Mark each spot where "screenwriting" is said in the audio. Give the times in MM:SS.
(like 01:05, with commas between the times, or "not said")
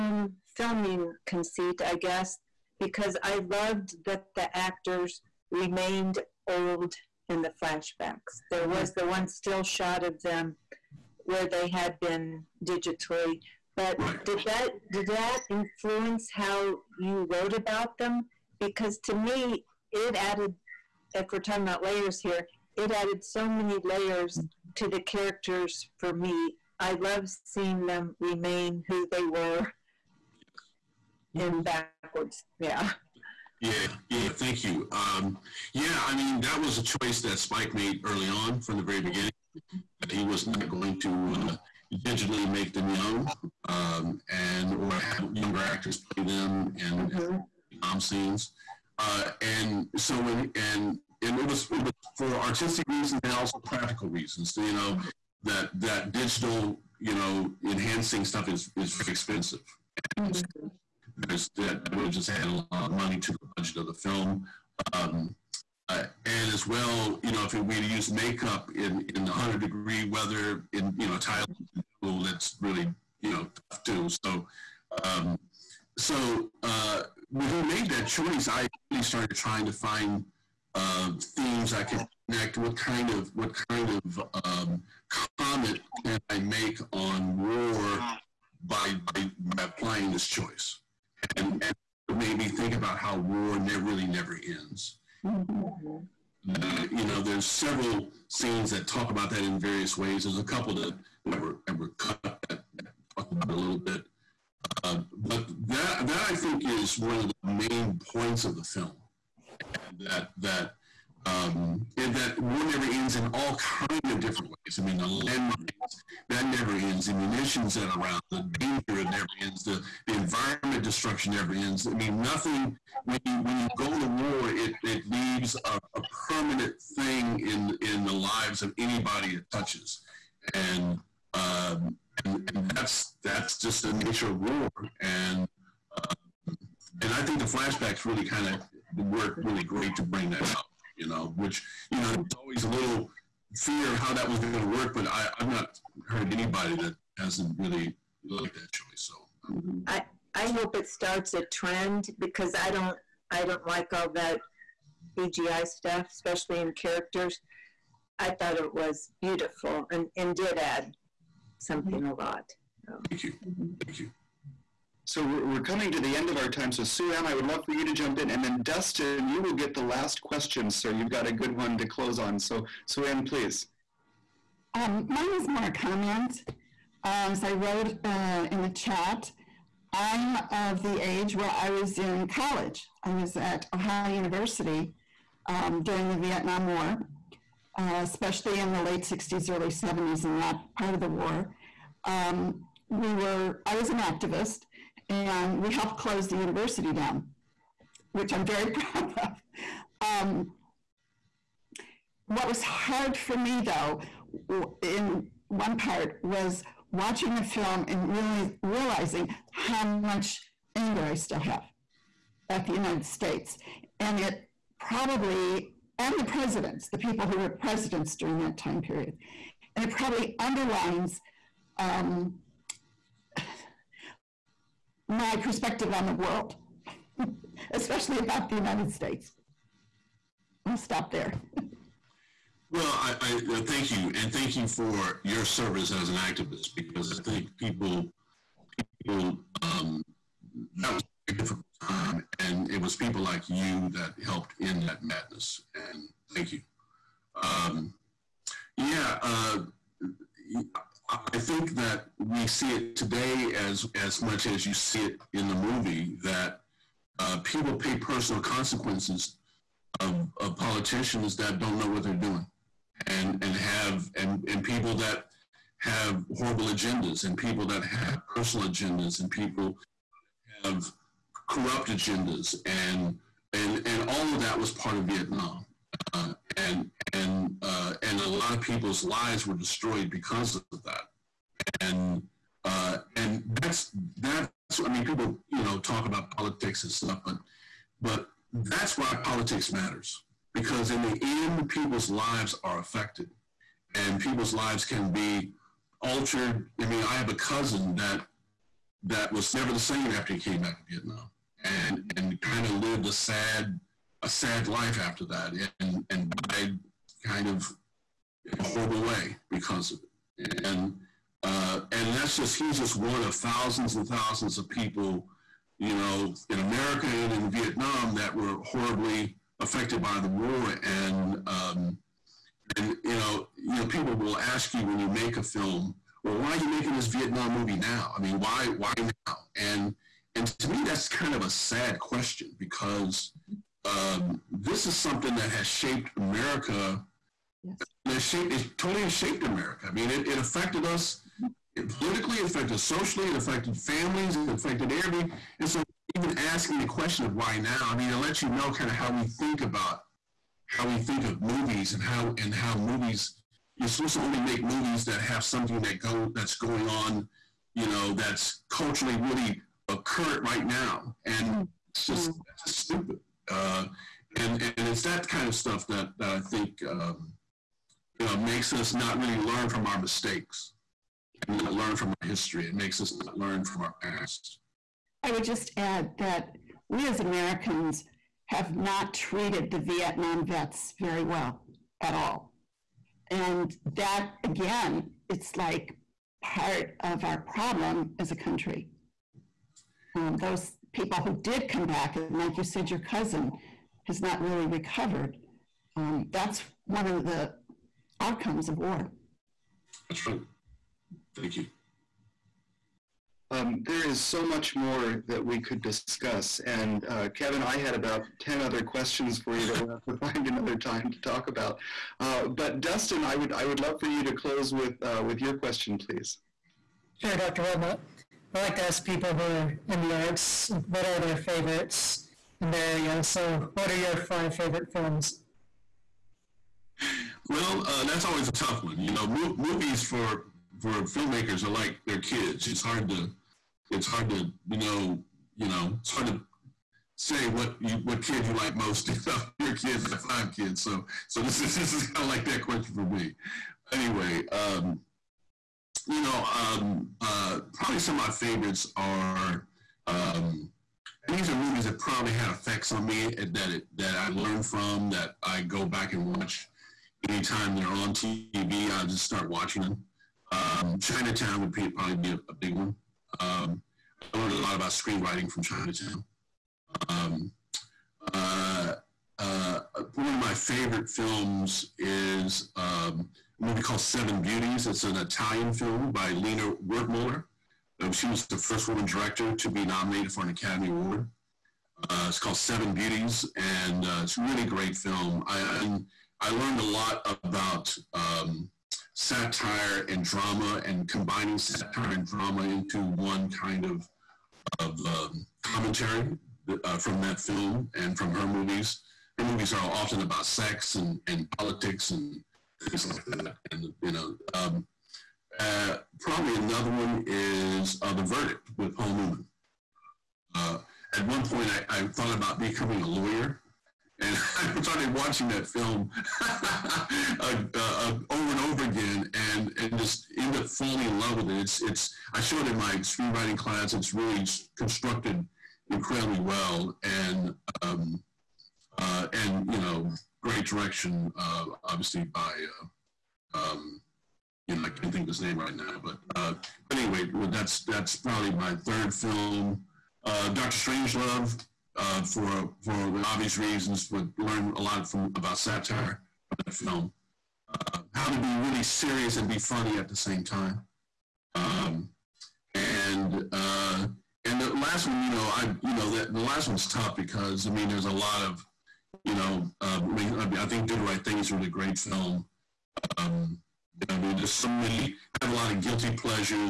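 07:44, 08:42.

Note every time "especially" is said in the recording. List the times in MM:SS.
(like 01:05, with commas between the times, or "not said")
02:36, 03:08, 03:47.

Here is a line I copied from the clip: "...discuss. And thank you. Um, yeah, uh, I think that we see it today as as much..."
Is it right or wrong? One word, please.
wrong.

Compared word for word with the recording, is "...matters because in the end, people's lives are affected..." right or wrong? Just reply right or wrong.
right.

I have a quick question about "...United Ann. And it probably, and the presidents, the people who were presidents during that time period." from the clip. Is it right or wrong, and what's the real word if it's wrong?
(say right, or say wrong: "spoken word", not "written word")
wrong: "States", not "Ann".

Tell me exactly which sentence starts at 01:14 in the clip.
So, um, so uh, when he made that choice, I really started trying to find uh, themes I could connect.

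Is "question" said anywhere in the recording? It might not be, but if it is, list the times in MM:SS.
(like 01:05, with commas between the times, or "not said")
02:50, 05:31, 05:46, 06:48, 06:55, 07:22.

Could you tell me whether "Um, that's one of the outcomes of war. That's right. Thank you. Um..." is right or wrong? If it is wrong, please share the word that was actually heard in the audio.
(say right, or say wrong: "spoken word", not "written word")
right.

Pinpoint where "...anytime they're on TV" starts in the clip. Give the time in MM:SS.
07:37.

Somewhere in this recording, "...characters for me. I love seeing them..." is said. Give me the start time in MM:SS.
00:24.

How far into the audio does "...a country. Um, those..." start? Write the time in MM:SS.
06:28.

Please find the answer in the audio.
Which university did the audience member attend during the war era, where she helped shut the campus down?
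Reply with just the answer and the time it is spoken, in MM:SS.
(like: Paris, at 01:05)
Ohio University, at 03:03.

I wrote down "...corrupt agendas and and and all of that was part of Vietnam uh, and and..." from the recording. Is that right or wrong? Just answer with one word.
right.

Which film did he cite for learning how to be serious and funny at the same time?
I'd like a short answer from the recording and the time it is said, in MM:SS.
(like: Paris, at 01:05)
Doctor Strangelove, at 09:00.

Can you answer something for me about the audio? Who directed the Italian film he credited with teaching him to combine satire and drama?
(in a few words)
Lina Wertmuller.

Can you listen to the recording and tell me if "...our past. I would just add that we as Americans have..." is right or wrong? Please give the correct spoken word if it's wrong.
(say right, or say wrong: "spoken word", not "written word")
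right.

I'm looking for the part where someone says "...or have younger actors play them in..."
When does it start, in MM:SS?
00:44.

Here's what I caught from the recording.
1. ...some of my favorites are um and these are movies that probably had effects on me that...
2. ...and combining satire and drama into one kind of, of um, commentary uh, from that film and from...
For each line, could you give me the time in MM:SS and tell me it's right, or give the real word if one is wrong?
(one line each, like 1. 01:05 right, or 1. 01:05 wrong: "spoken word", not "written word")
1. 07:27 right
2. 08:10 right.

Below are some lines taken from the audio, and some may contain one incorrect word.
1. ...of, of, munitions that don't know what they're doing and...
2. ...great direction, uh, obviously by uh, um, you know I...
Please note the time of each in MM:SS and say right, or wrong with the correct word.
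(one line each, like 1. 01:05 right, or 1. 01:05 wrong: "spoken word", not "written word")
1. 04:19 wrong: "politicians", not "munitions"
2. 08:50 right.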